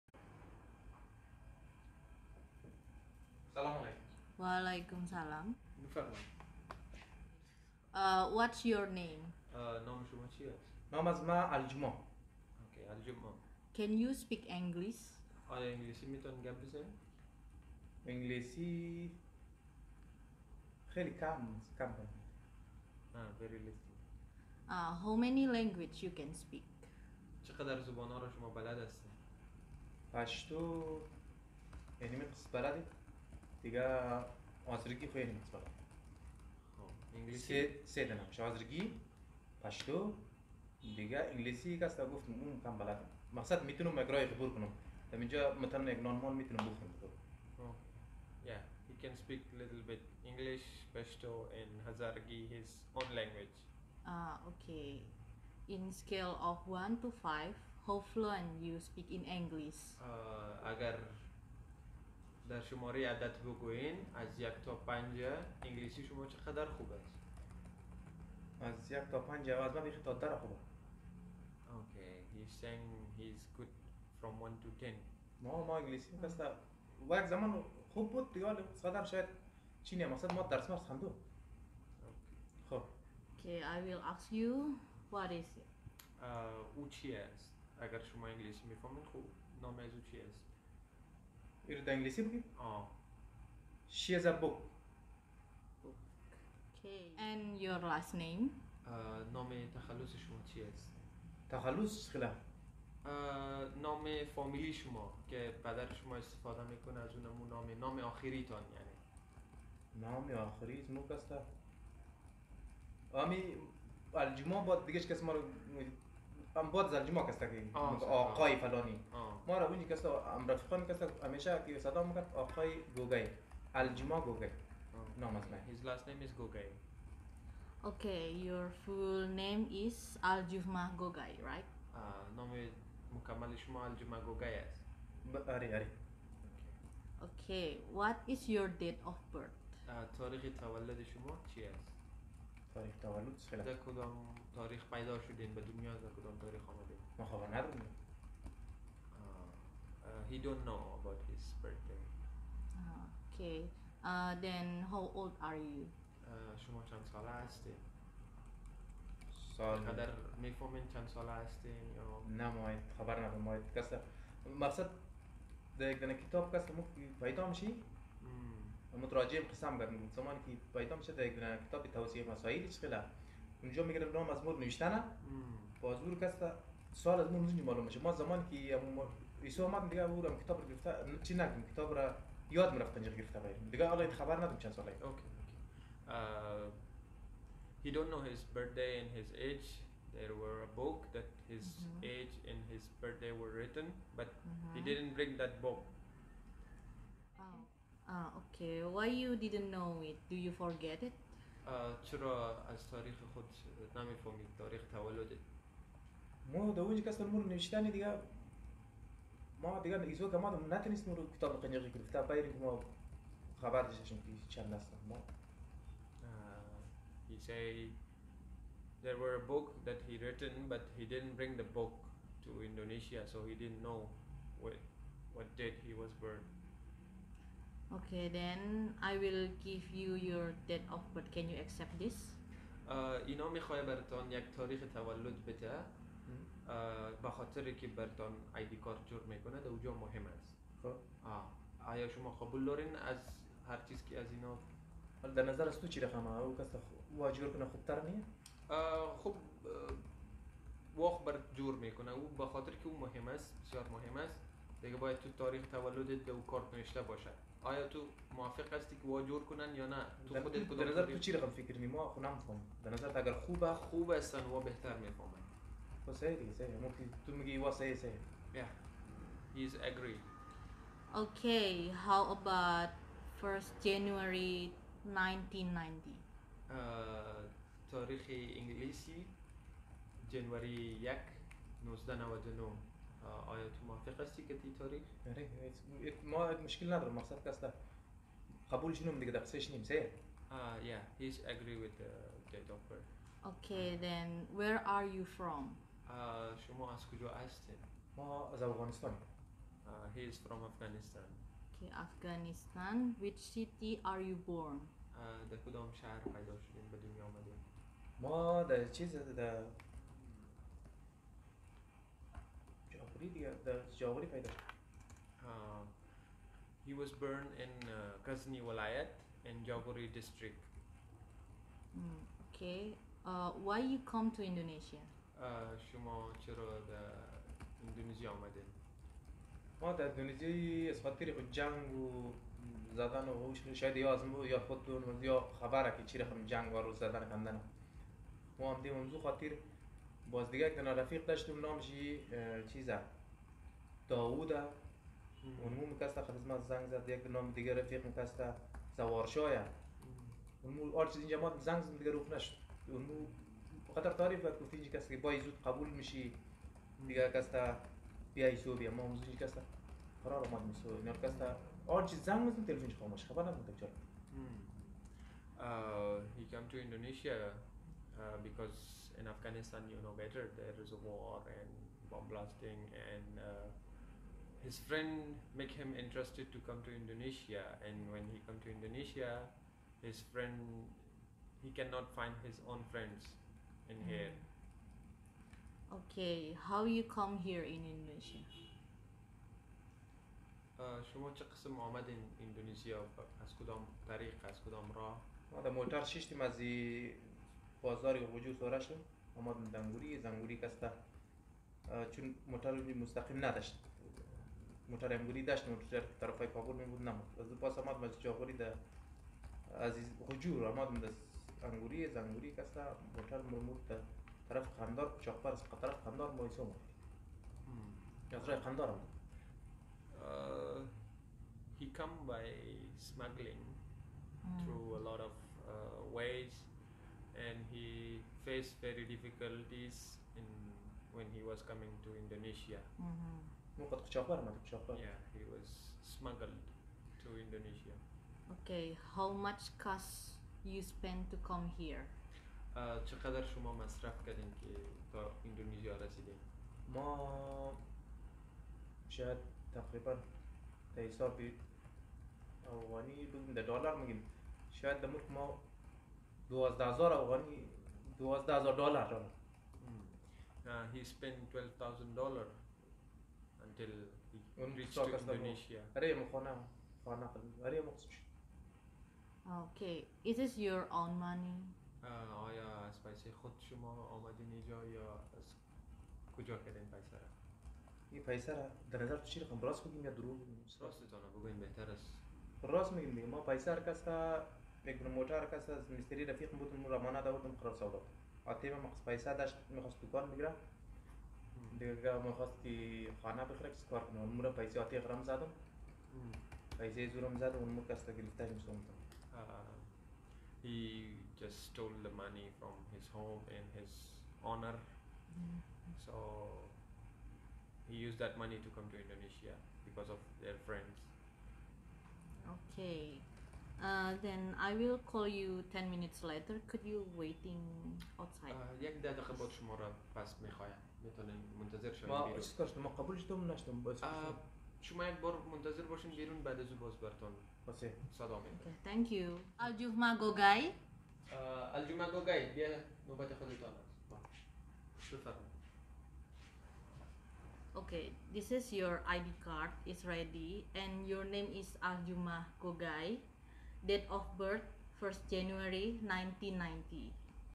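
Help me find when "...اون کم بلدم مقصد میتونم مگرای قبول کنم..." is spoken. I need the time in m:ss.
0:42.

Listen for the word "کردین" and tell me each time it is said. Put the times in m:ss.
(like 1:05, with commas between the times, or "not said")
7:24, 7:56.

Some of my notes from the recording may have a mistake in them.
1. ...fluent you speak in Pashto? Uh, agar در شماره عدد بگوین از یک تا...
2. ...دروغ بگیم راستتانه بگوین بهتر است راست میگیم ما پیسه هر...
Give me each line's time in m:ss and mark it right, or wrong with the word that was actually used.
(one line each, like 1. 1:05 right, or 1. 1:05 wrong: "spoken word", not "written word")
1. 0:58 wrong: "English", not "Pashto"
2. 8:00 right.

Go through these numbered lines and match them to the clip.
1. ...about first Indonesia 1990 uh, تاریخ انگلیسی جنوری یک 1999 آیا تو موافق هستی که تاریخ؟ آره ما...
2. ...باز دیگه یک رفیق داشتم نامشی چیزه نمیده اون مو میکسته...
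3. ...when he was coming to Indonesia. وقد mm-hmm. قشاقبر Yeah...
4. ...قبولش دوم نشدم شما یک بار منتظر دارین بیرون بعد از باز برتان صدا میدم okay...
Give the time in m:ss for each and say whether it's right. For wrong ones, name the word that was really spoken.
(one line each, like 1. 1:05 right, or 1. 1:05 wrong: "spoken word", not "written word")
1. 4:32 wrong: "January", not "Indonesia"
2. 5:40 wrong: "داووده", not "نمیده"
3. 7:11 right
4. 8:42 wrong: "باشین", not "دارین".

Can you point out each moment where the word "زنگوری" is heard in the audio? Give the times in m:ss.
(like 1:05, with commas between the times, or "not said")
6:40, 6:52.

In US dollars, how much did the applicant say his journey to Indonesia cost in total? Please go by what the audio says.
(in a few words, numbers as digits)
$12,000.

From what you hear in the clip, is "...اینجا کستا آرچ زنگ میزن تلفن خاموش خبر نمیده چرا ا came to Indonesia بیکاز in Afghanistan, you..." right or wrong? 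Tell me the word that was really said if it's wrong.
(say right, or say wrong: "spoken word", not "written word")
right.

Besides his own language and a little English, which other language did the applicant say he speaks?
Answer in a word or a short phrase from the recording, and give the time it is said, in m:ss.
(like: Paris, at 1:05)
Pashto, at 0:50.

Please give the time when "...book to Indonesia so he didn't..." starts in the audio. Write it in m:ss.
3:41.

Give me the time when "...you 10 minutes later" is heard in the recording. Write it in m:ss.
8:35.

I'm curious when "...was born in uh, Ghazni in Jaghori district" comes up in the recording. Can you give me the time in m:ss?
5:16.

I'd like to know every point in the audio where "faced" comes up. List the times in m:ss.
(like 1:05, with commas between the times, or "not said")
7:08.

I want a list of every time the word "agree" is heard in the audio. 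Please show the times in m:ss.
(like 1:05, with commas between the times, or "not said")
4:29, 4:51.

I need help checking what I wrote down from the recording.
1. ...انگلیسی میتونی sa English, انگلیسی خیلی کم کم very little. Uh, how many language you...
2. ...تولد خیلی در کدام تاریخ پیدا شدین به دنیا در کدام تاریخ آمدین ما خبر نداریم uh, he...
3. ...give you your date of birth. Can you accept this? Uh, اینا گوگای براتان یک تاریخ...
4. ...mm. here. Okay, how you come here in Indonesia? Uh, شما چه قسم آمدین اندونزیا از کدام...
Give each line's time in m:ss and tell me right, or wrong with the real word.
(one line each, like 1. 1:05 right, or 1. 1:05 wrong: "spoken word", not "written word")
1. 0:15 right
2. 2:23 right
3. 3:49 wrong: "میخوای", not "گوگای"
4. 6:24 right.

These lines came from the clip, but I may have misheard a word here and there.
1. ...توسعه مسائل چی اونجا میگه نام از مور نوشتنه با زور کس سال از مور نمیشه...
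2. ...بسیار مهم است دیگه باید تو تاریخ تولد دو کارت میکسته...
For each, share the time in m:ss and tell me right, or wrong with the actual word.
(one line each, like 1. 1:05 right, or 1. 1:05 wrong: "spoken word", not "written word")
1. 2:51 right
2. 4:13 wrong: "نوشته", not "میکسته".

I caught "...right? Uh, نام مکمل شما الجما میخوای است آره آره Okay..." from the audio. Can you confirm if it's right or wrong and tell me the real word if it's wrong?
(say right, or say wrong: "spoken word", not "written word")
wrong: "گوگای", not "میخوای".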